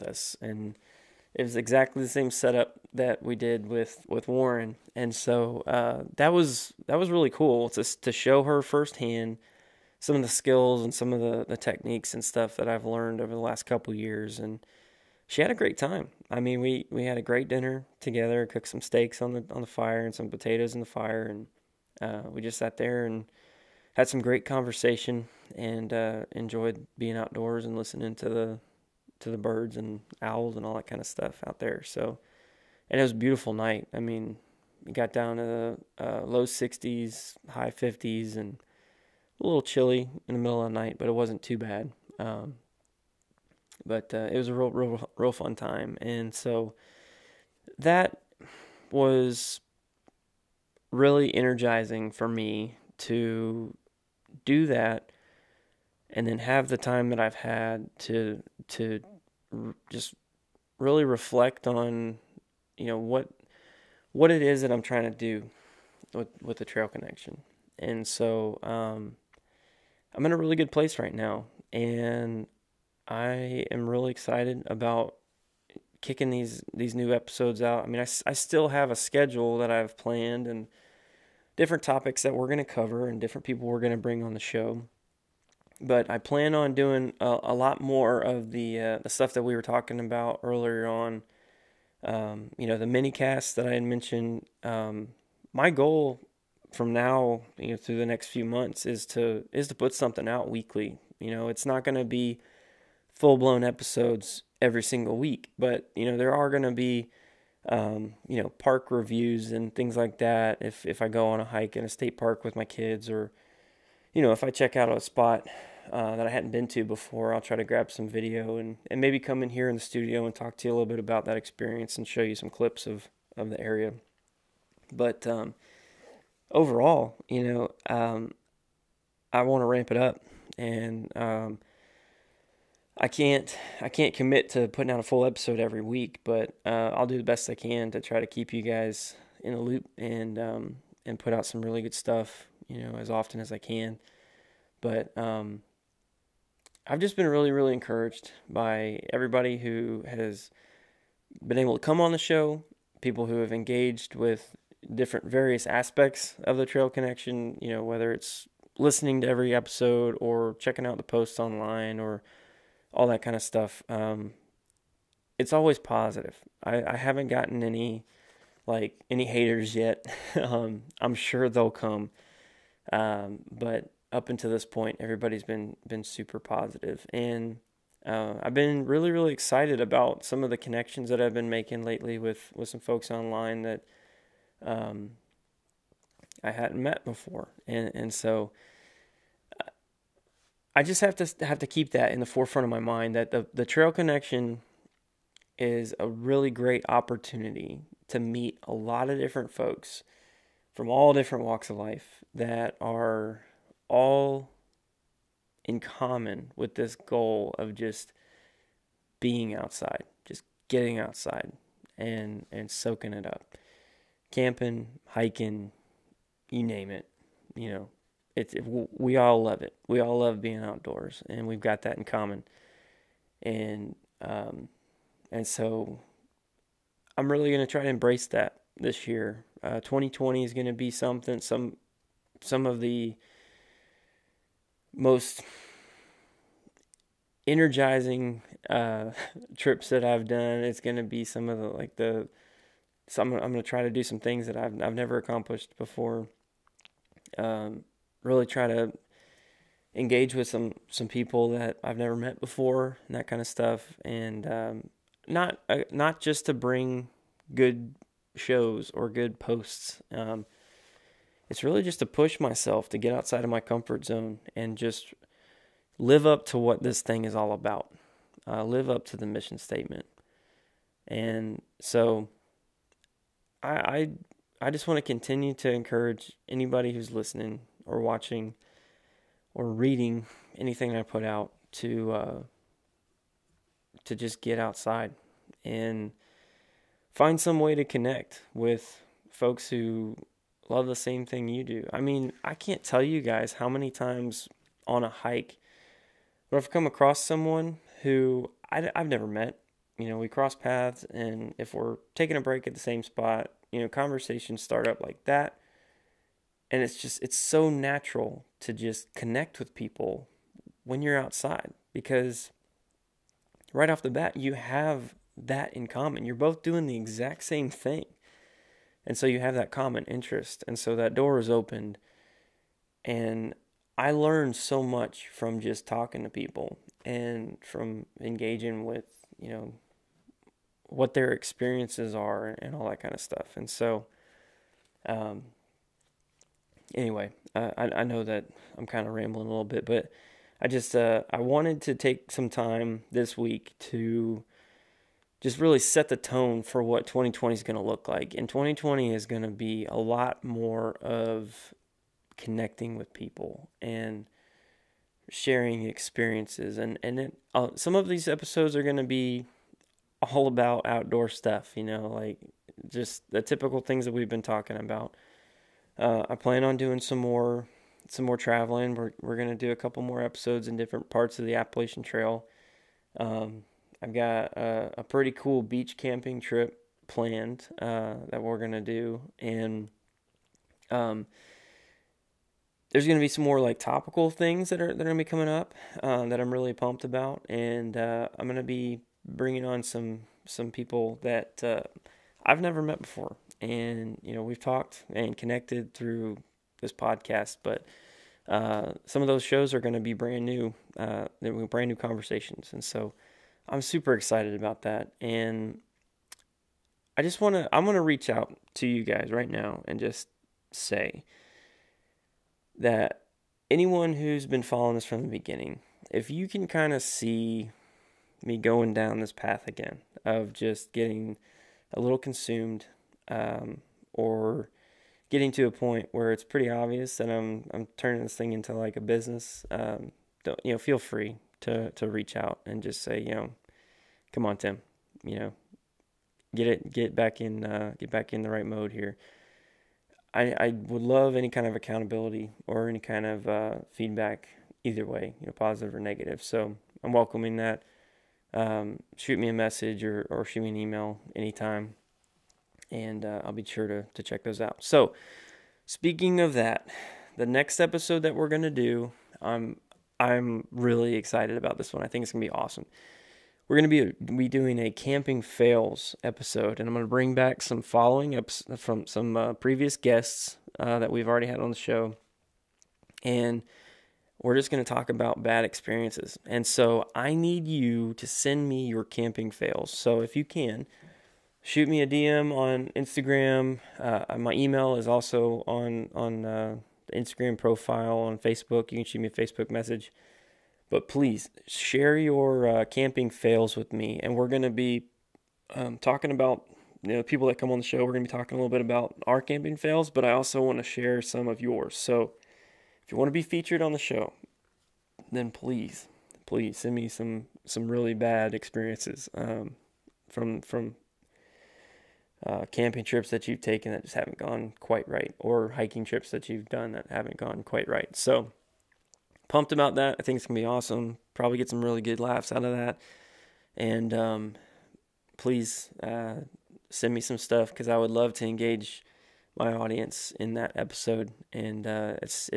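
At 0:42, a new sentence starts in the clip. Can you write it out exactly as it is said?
Um, but uh, it was a real, real, real fun time.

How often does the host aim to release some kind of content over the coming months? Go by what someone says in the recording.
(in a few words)
weekly.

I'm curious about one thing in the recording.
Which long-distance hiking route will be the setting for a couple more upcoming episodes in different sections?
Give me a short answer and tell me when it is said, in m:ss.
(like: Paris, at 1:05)
Appalachian Trail, at 6:11.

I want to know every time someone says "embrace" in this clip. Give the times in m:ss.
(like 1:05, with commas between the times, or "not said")
3:47.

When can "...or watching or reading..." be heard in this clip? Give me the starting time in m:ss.
4:37.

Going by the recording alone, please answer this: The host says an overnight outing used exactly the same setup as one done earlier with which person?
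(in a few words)
Warren.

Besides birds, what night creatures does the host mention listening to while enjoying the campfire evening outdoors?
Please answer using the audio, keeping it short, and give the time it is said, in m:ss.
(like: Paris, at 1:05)
owls, at 0:30.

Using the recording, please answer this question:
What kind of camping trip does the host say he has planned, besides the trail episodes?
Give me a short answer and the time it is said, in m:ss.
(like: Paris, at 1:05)
beach camping, at 6:15.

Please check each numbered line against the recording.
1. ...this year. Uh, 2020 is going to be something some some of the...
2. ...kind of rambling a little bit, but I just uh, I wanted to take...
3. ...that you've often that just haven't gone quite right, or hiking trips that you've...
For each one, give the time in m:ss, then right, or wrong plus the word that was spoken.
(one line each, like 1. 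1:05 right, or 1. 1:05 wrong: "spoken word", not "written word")
1. 3:48 right
2. 5:38 right
3. 8:33 wrong: "taken", not "often".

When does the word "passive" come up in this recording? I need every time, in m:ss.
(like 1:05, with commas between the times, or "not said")
not said.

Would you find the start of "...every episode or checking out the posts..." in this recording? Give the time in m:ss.
2:39.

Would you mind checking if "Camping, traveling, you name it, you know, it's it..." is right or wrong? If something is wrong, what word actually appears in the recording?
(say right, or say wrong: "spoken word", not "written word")
wrong: "hiking", not "traveling".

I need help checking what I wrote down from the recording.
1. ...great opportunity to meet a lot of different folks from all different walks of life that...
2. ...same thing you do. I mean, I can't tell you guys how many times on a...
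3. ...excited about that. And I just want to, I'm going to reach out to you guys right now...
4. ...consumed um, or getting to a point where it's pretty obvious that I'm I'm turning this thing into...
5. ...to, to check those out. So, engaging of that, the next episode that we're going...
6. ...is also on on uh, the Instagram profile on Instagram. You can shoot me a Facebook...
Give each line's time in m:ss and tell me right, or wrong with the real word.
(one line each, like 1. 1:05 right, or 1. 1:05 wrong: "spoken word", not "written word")
1. 3:16 right
2. 4:50 right
3. 6:44 right
4. 7:02 right
5. 7:33 wrong: "speaking", not "engaging"
6. 8:04 wrong: "Facebook", not "Instagram".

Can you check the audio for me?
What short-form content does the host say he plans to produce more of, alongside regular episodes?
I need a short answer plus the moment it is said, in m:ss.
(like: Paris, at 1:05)
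mini casts, at 1:32.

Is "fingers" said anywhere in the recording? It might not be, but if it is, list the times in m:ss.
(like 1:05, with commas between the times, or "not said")
not said.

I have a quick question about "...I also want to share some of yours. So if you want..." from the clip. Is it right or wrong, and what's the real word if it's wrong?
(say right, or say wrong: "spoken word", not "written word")
right.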